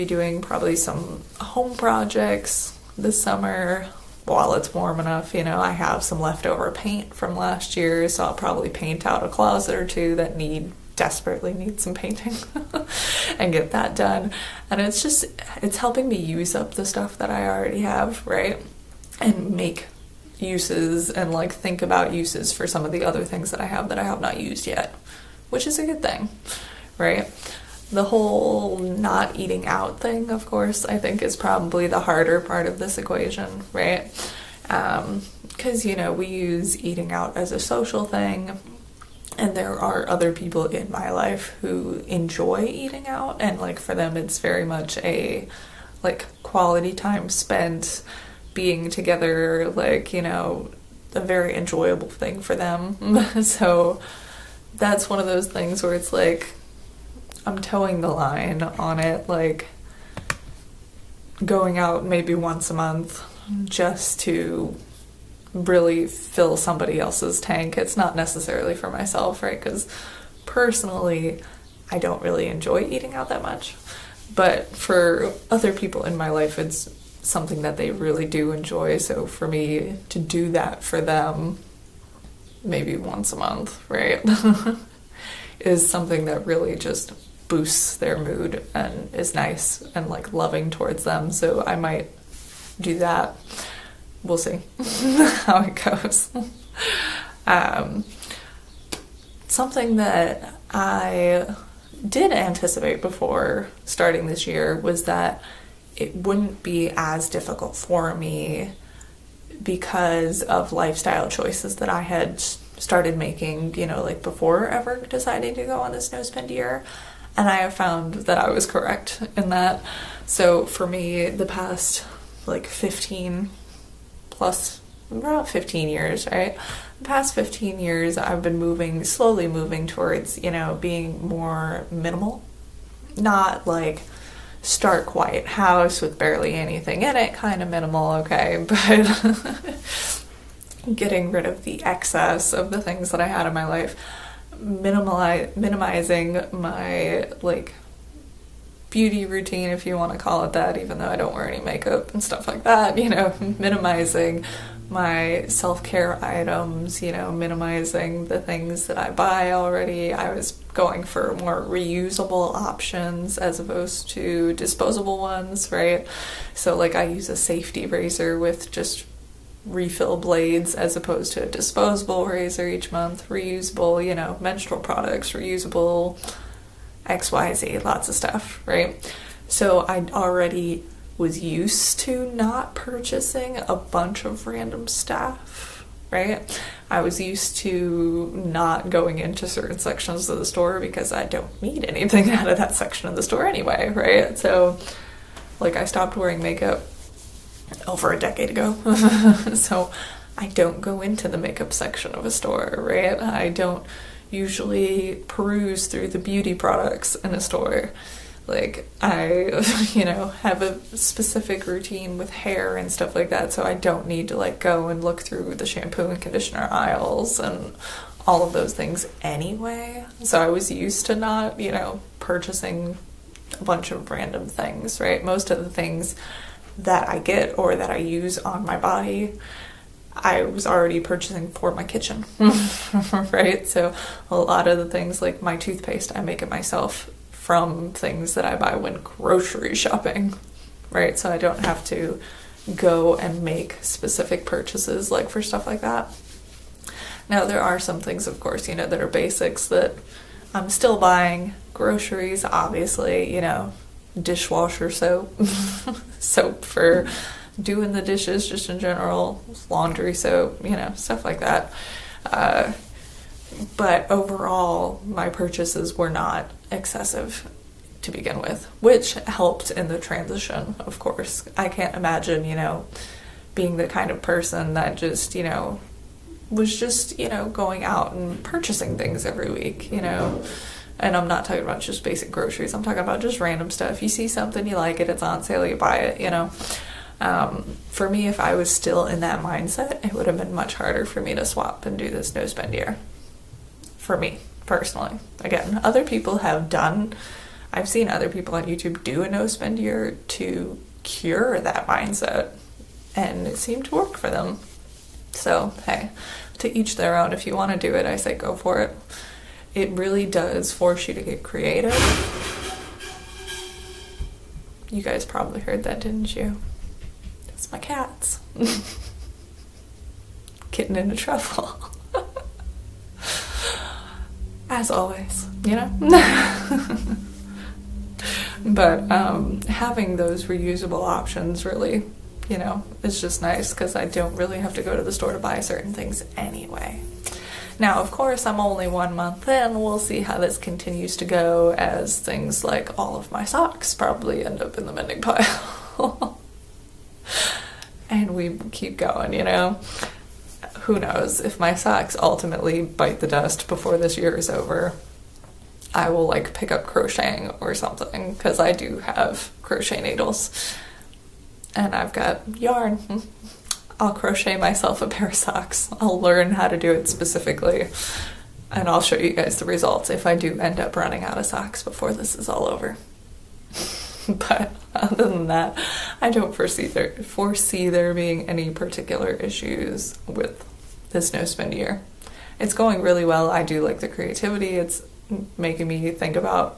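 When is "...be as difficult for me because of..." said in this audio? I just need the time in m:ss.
1:46.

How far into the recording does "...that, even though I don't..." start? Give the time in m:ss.
2:30.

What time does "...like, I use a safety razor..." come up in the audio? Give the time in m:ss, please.
2:46.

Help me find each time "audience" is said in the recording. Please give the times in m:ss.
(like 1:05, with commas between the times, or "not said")
not said.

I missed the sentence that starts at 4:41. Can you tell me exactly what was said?
And I'm not talking about just basic groceries.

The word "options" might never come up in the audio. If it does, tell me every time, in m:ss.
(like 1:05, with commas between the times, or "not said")
2:42, 5:31.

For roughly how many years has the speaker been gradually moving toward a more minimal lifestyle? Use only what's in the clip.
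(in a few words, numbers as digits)
15.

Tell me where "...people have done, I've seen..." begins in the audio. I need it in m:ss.
4:56.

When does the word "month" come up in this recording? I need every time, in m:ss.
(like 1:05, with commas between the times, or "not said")
1:02, 1:23, 2:52, 5:39.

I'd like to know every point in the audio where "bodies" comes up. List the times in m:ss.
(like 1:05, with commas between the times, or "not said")
not said.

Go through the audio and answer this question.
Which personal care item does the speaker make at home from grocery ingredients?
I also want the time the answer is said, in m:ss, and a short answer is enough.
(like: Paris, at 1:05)
toothpaste, at 3:55.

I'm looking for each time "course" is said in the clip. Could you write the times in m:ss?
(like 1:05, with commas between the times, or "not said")
0:30, 4:08, 4:30, 5:38.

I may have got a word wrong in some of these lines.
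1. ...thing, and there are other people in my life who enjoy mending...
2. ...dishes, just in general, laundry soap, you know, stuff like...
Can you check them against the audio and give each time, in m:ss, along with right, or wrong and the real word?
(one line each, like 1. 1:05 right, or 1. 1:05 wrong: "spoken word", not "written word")
1. 0:38 wrong: "eating", not "mending"
2. 4:18 right.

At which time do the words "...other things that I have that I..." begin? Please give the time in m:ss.
0:23.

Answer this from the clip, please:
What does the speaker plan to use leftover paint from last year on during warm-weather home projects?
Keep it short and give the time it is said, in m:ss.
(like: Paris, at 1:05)
a closet or two, at 0:09.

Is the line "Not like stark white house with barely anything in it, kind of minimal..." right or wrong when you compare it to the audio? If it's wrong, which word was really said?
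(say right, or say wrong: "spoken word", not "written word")
right.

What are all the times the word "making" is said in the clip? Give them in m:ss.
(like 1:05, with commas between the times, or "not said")
1:53, 6:25.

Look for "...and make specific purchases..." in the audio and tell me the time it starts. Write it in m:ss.
4:03.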